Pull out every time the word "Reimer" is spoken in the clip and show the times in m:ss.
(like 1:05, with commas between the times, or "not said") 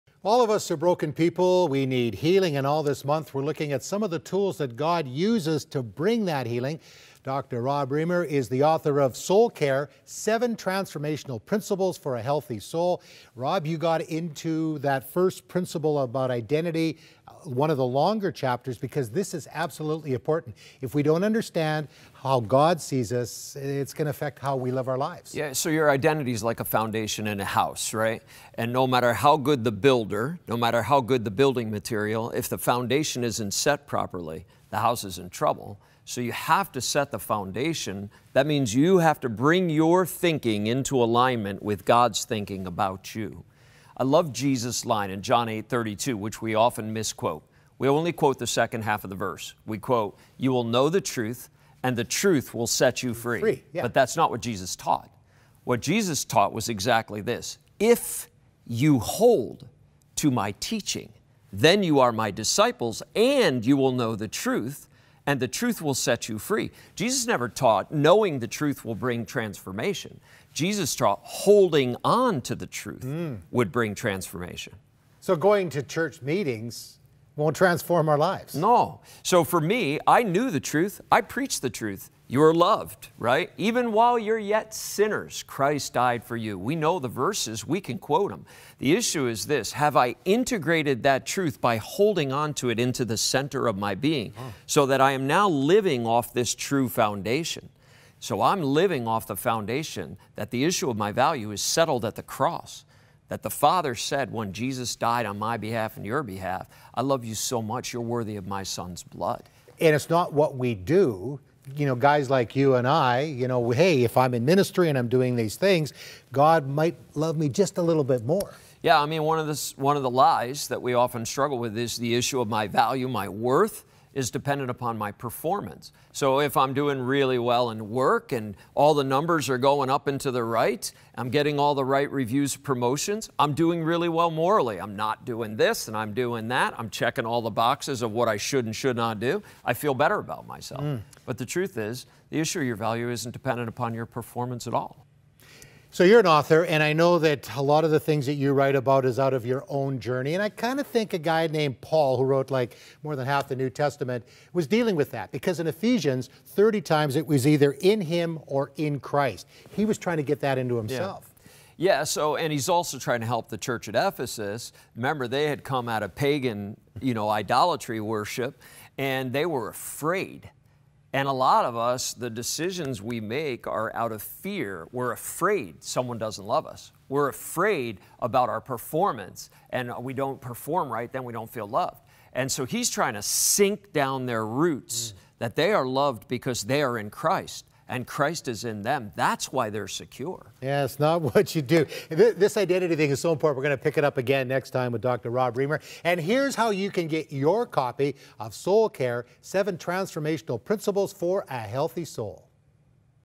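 0:07, 3:15.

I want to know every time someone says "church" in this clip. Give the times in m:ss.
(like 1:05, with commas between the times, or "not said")
1:15, 2:43.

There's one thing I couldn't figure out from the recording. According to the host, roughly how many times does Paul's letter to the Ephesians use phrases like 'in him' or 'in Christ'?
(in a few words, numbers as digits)
30.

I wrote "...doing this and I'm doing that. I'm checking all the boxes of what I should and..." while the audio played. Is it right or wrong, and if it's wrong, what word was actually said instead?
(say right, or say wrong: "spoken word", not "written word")
right.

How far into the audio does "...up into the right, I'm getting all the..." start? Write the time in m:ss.
2:09.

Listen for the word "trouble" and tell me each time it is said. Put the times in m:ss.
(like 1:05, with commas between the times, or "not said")
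0:35.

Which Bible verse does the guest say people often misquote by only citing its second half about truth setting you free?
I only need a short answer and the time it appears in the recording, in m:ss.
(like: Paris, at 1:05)
John 8:32, at 0:45.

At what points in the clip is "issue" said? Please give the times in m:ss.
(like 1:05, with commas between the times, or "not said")
1:28, 1:40, 2:02, 2:22.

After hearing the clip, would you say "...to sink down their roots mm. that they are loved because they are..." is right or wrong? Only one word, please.
right.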